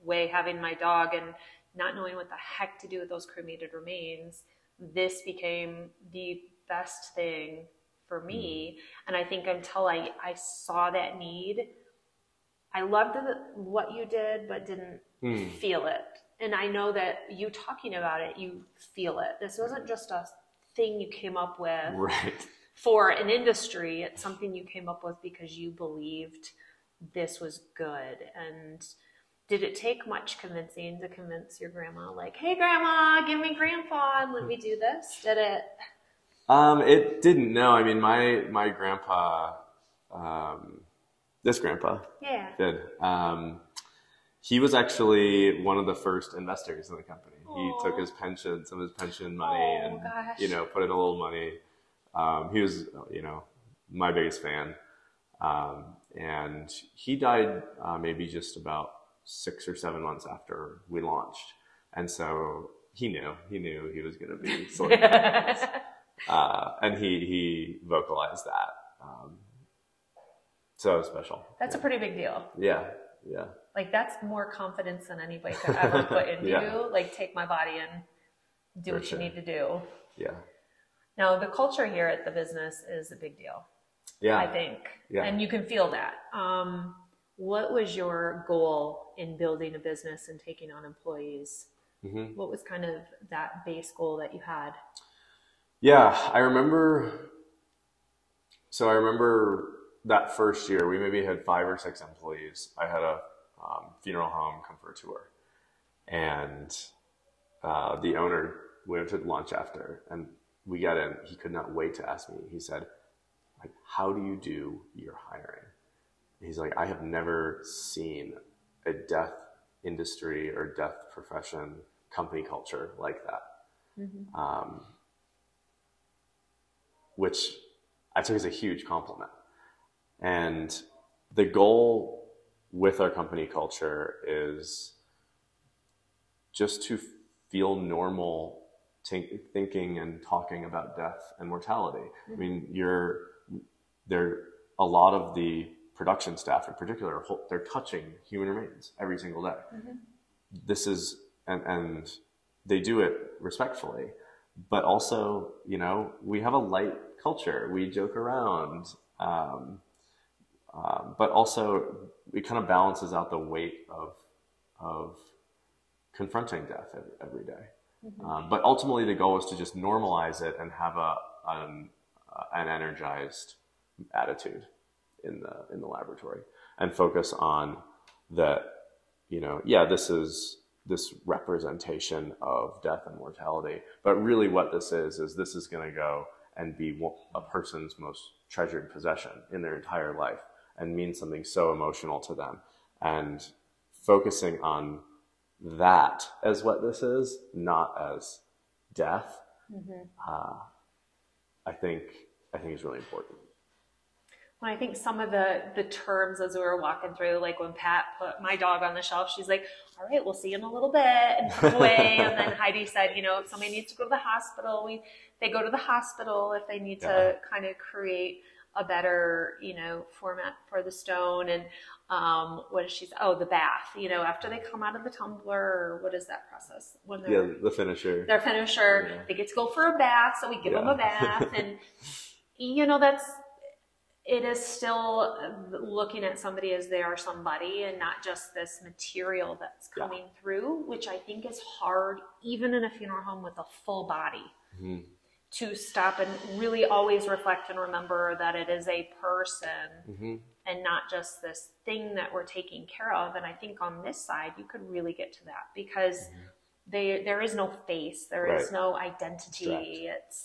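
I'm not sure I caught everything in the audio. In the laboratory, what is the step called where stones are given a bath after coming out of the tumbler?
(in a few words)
The finisher.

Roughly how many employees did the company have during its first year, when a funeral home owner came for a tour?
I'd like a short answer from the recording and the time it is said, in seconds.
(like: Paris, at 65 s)
5 or 6, at 101 s.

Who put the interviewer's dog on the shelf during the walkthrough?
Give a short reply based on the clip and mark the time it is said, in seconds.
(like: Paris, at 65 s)
Pat, at 207 s.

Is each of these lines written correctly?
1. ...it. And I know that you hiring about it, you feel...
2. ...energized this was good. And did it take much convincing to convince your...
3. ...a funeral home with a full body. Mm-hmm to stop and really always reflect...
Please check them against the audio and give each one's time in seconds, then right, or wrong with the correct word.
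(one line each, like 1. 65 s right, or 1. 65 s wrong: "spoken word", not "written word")
1. 15 s wrong: "talking", not "hiring"
2. 25 s wrong: "believed", not "energized"
3. 242 s right.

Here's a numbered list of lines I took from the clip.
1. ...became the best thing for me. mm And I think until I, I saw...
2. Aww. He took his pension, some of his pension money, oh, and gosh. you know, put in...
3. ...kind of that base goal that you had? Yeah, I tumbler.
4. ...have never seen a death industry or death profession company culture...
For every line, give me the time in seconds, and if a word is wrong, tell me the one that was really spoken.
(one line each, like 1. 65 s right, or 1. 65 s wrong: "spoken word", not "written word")
1. 5 s right
2. 47 s right
3. 92 s wrong: "remember", not "tumbler"
4. 116 s right.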